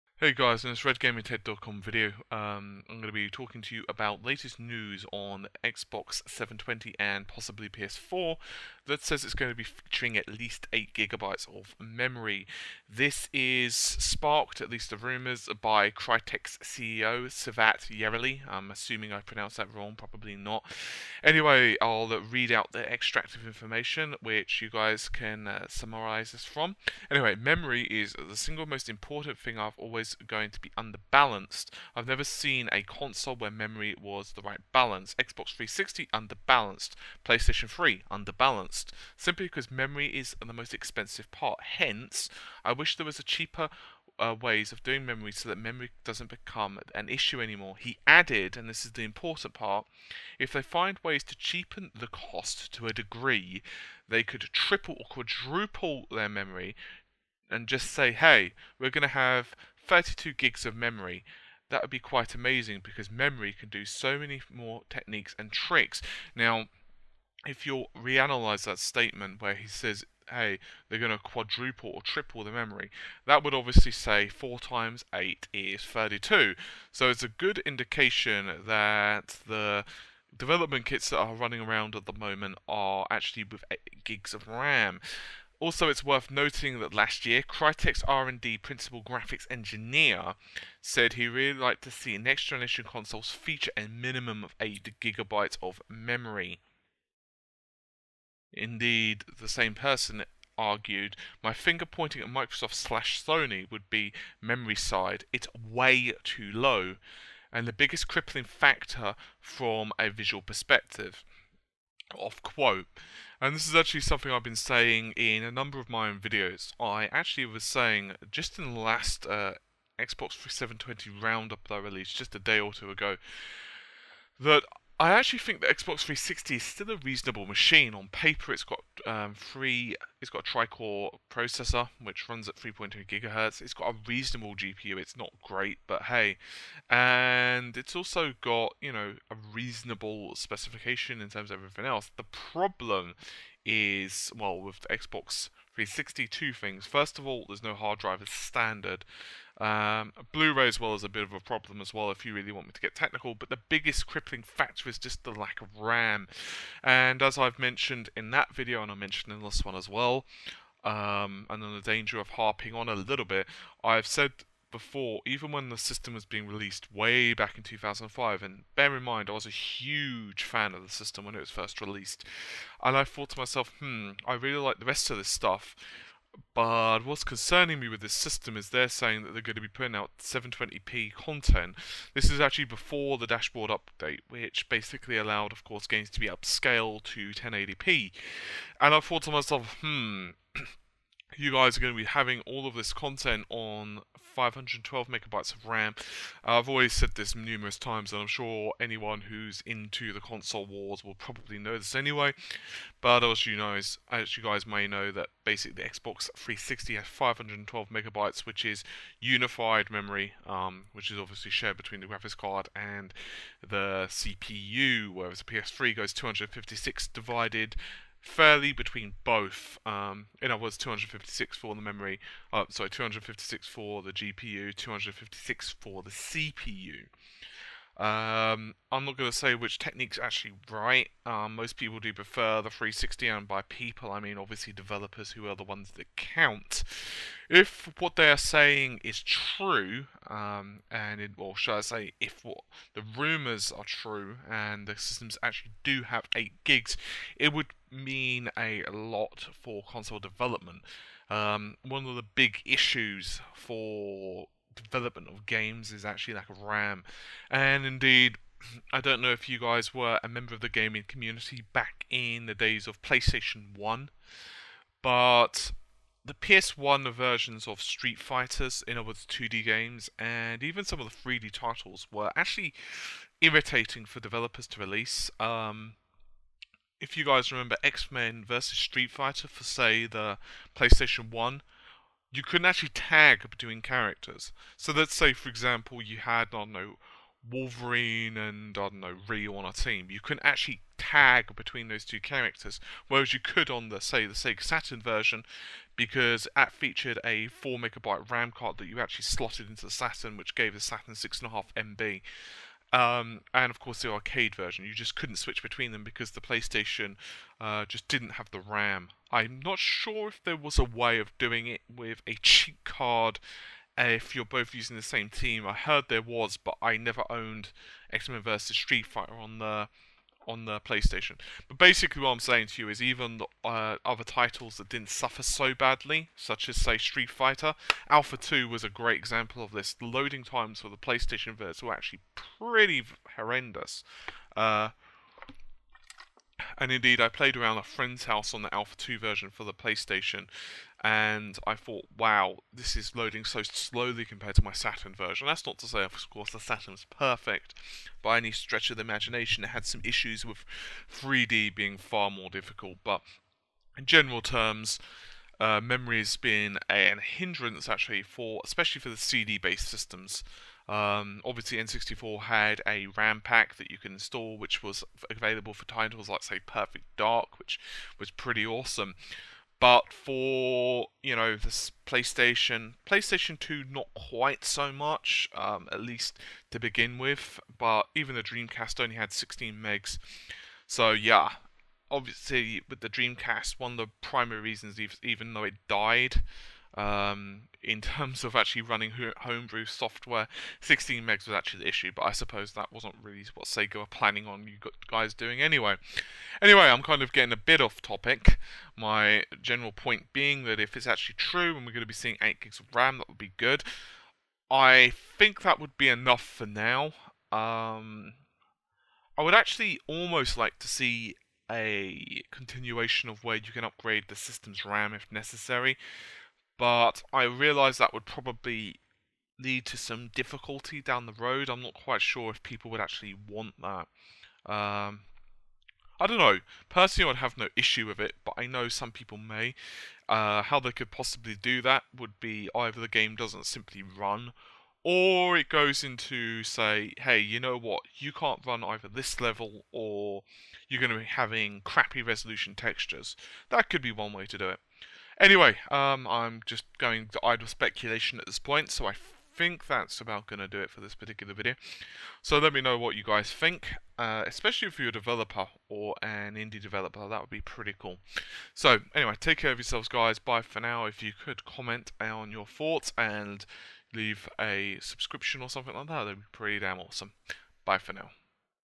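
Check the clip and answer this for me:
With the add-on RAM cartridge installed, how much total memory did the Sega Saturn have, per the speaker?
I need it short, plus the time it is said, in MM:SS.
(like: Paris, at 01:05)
6.5 MB, at 05:01.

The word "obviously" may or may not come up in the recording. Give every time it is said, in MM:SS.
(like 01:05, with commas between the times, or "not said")
01:13, 03:31, 03:54, 06:01, 06:22.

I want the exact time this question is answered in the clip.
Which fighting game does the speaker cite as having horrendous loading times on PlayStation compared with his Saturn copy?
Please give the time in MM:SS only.
05:26.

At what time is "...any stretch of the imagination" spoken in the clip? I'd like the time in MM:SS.
05:48.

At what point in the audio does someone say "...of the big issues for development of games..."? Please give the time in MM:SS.
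04:12.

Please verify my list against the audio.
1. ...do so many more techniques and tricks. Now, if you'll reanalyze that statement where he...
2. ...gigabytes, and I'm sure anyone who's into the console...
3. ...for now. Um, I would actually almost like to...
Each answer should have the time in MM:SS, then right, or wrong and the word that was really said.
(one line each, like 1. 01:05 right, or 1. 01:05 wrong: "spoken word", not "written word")
1. 01:03 right
2. 03:17 wrong: "times", not "gigabytes"
3. 06:46 right.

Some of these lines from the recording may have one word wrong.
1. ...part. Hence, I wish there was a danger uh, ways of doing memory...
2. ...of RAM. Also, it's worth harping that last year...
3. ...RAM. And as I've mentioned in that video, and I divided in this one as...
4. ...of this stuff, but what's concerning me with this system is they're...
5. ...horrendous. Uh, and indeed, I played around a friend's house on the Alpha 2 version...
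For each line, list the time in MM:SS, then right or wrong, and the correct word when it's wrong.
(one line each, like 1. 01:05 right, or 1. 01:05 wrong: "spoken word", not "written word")
1. 00:41 wrong: "cheaper", not "danger"
2. 01:24 wrong: "noting", not "harping"
3. 02:35 wrong: "mentioned", not "divided"
4. 02:55 right
5. 05:33 right.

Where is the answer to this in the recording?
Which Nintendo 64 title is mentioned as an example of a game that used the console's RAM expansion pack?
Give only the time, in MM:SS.
06:06.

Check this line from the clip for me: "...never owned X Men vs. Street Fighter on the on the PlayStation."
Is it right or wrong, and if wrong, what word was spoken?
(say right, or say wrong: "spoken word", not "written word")
right.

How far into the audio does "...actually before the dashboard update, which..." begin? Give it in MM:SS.
03:02.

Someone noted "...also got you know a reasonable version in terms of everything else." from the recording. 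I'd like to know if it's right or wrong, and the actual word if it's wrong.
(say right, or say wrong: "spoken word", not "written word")
wrong: "specification", not "version".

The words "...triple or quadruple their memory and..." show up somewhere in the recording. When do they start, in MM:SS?
00:54.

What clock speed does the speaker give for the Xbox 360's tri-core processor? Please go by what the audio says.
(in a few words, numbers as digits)
3.2 gigahertz.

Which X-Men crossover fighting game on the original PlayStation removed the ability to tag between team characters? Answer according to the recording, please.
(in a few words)
X Men versus Street Fighter.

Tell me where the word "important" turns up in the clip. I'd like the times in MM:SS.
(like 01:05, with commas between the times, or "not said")
00:28, 00:49.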